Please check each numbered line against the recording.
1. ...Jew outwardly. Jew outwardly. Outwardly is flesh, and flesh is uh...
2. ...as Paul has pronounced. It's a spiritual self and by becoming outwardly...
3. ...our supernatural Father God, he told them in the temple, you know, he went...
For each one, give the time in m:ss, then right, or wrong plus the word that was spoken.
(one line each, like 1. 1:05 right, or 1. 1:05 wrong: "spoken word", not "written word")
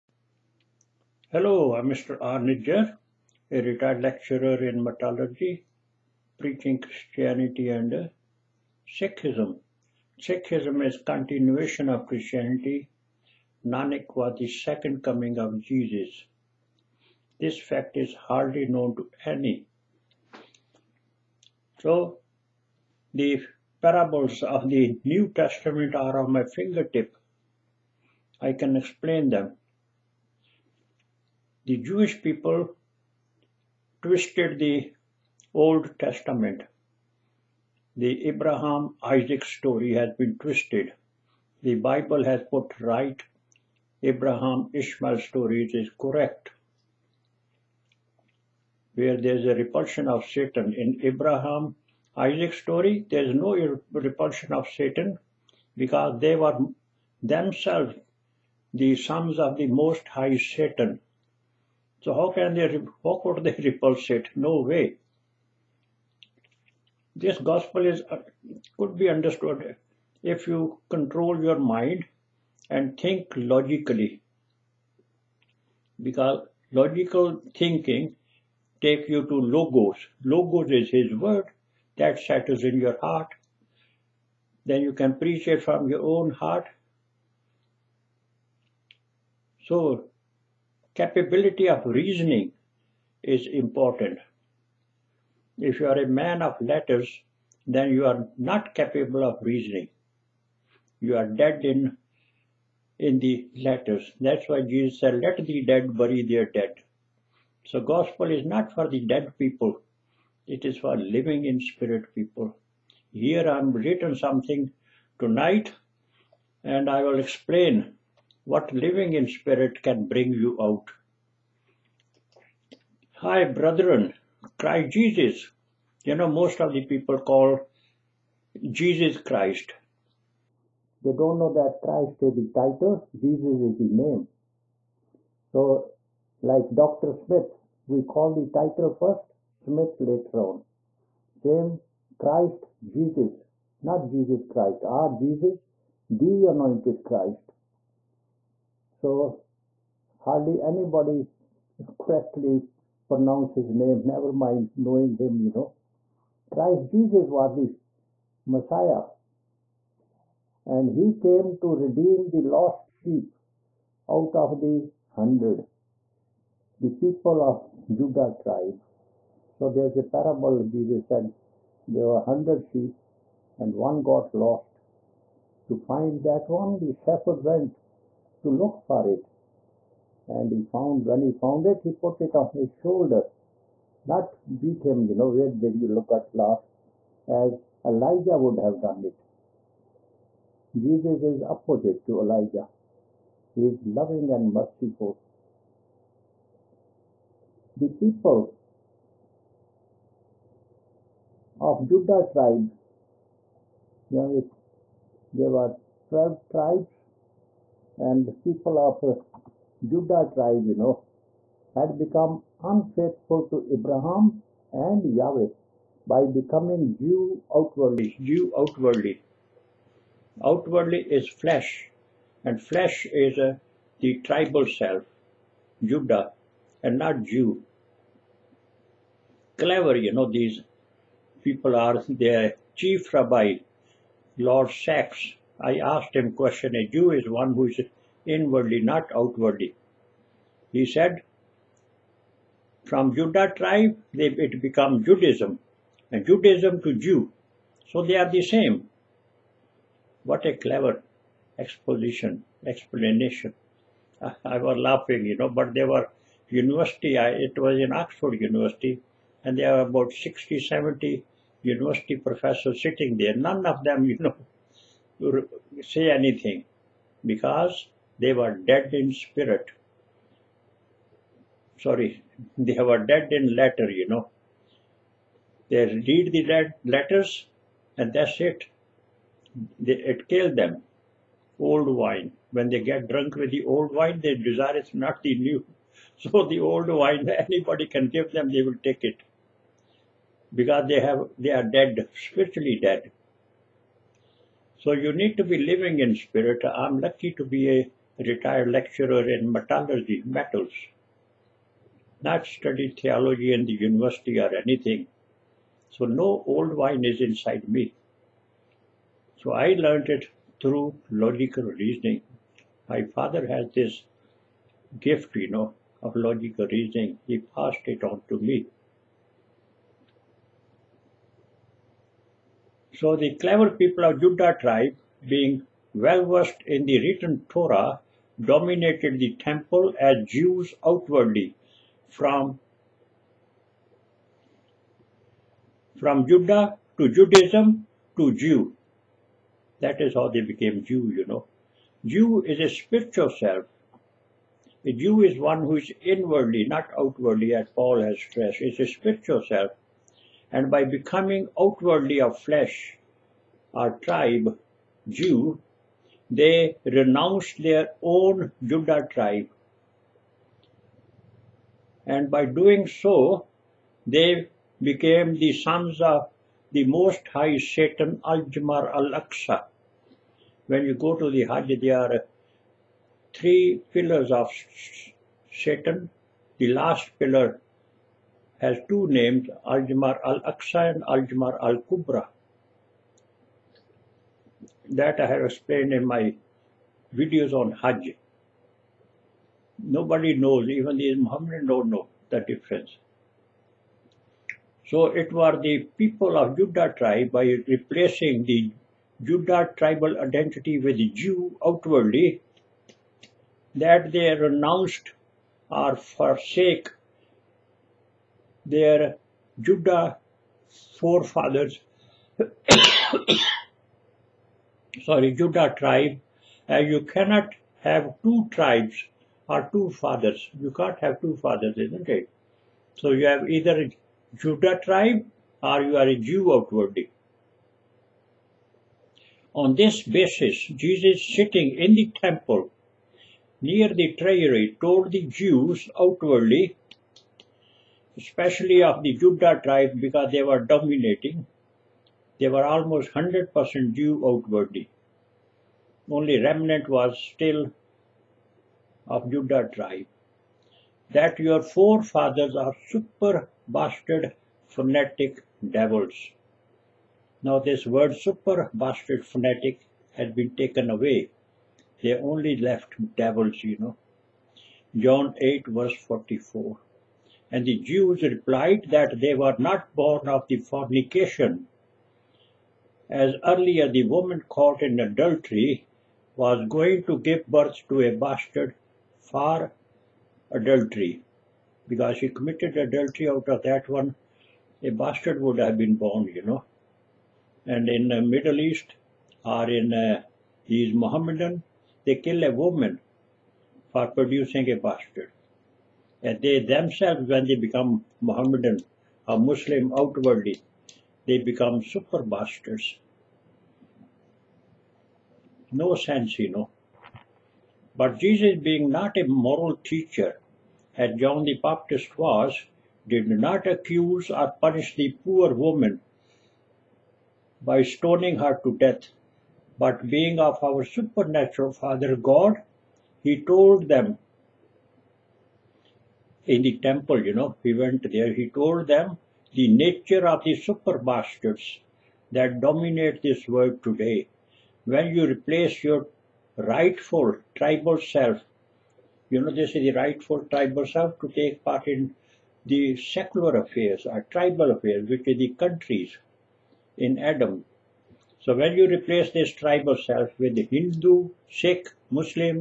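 1. 3:36 right
2. 5:47 wrong: "stressed", not "pronounced"
3. 8:40 right.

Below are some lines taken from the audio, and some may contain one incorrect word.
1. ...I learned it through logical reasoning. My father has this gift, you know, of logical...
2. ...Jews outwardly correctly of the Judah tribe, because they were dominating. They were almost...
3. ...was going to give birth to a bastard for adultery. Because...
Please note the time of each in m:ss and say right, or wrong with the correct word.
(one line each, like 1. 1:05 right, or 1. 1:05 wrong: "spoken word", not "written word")
1. 5:09 right
2. 7:15 wrong: "especially", not "correctly"
3. 7:56 right.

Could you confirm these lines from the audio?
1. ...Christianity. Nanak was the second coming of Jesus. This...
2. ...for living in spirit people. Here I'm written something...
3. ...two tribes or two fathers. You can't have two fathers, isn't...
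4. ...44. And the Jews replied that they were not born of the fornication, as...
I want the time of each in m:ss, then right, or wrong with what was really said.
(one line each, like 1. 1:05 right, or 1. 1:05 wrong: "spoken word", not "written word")
1. 0:12 right
2. 1:50 right
3. 6:58 right
4. 7:46 right.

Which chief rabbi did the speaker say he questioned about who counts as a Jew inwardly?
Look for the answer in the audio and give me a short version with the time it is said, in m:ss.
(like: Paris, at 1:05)
Lord Sacks, at 3:54.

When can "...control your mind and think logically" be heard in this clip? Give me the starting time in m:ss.
1:10.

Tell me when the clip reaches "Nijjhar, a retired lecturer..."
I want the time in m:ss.
0:02.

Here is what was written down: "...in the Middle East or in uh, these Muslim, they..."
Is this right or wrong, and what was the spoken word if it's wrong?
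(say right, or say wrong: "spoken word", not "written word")
wrong: "Mohammedan", not "Muslim".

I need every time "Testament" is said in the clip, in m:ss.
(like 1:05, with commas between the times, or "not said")
0:25, 0:35.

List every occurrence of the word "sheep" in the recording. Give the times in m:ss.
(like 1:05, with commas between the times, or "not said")
2:42, 2:52.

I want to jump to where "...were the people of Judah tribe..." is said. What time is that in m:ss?
6:35.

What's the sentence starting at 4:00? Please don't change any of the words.
He said, from Judah tribe, they, it becomes Judaism, and Judaism to Jew.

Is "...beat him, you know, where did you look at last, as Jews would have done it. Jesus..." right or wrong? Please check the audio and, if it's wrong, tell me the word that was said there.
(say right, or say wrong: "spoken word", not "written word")
wrong: "Elijah", not "Jews".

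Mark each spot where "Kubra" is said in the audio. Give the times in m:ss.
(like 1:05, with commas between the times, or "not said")
6:21.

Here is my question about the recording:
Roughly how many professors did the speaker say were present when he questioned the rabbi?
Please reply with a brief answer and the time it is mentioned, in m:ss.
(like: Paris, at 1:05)
60 to 70, at 4:20.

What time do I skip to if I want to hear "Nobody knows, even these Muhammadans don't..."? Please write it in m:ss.
6:29.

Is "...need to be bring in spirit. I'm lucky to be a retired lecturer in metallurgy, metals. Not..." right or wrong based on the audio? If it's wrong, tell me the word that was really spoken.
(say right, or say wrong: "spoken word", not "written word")
wrong: "living", not "bring".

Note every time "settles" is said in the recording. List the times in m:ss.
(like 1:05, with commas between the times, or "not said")
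1:22.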